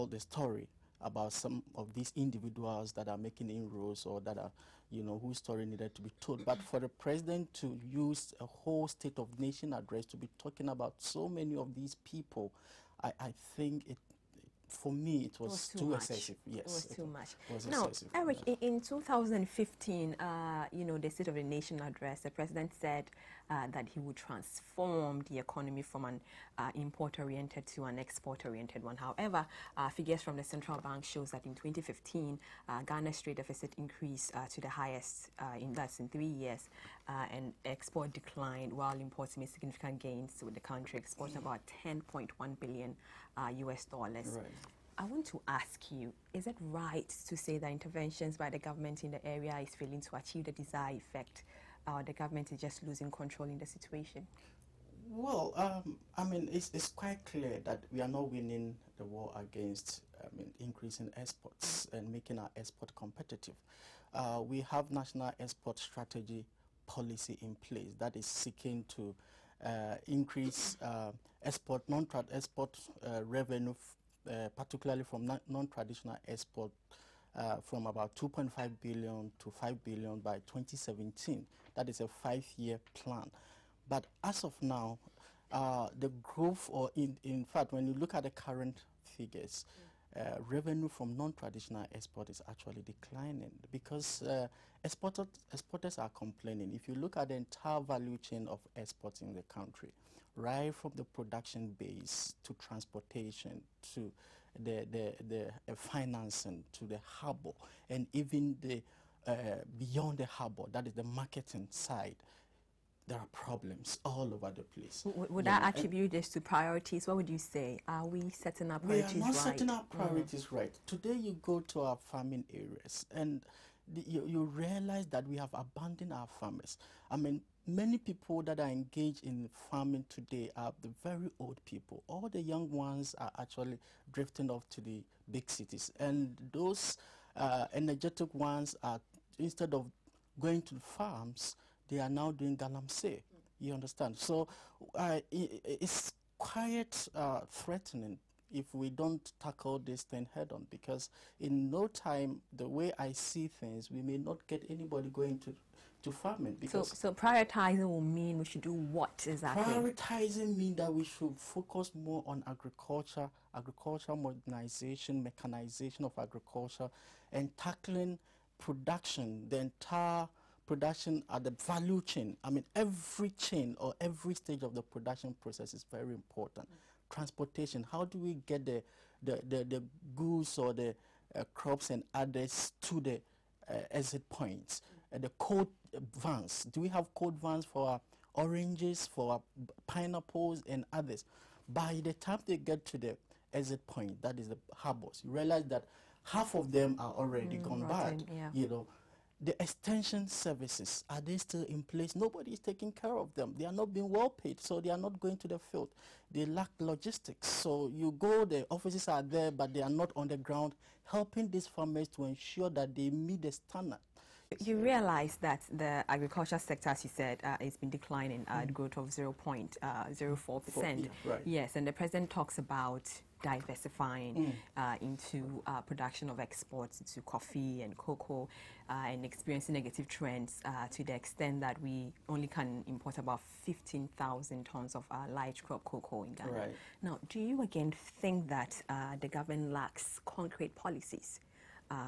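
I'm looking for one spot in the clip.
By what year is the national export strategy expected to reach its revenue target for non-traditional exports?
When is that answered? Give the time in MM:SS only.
01:20.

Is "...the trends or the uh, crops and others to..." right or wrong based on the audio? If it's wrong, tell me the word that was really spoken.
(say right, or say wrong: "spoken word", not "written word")
wrong: "goods", not "trends".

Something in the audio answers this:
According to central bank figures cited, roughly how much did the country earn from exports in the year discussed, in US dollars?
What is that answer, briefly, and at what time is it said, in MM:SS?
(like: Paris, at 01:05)
10.1 billion US dollars, at 00:41.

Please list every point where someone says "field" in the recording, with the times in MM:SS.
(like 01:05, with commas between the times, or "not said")
03:25.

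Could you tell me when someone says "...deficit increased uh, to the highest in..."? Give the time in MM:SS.
00:33.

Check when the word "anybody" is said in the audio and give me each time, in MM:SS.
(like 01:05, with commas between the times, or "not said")
02:34.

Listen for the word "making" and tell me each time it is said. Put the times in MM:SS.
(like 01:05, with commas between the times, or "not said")
00:03, 01:02.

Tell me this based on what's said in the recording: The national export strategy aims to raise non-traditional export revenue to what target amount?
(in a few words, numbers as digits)
5 billion.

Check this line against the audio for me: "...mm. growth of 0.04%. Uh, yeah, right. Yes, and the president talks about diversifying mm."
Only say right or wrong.
right.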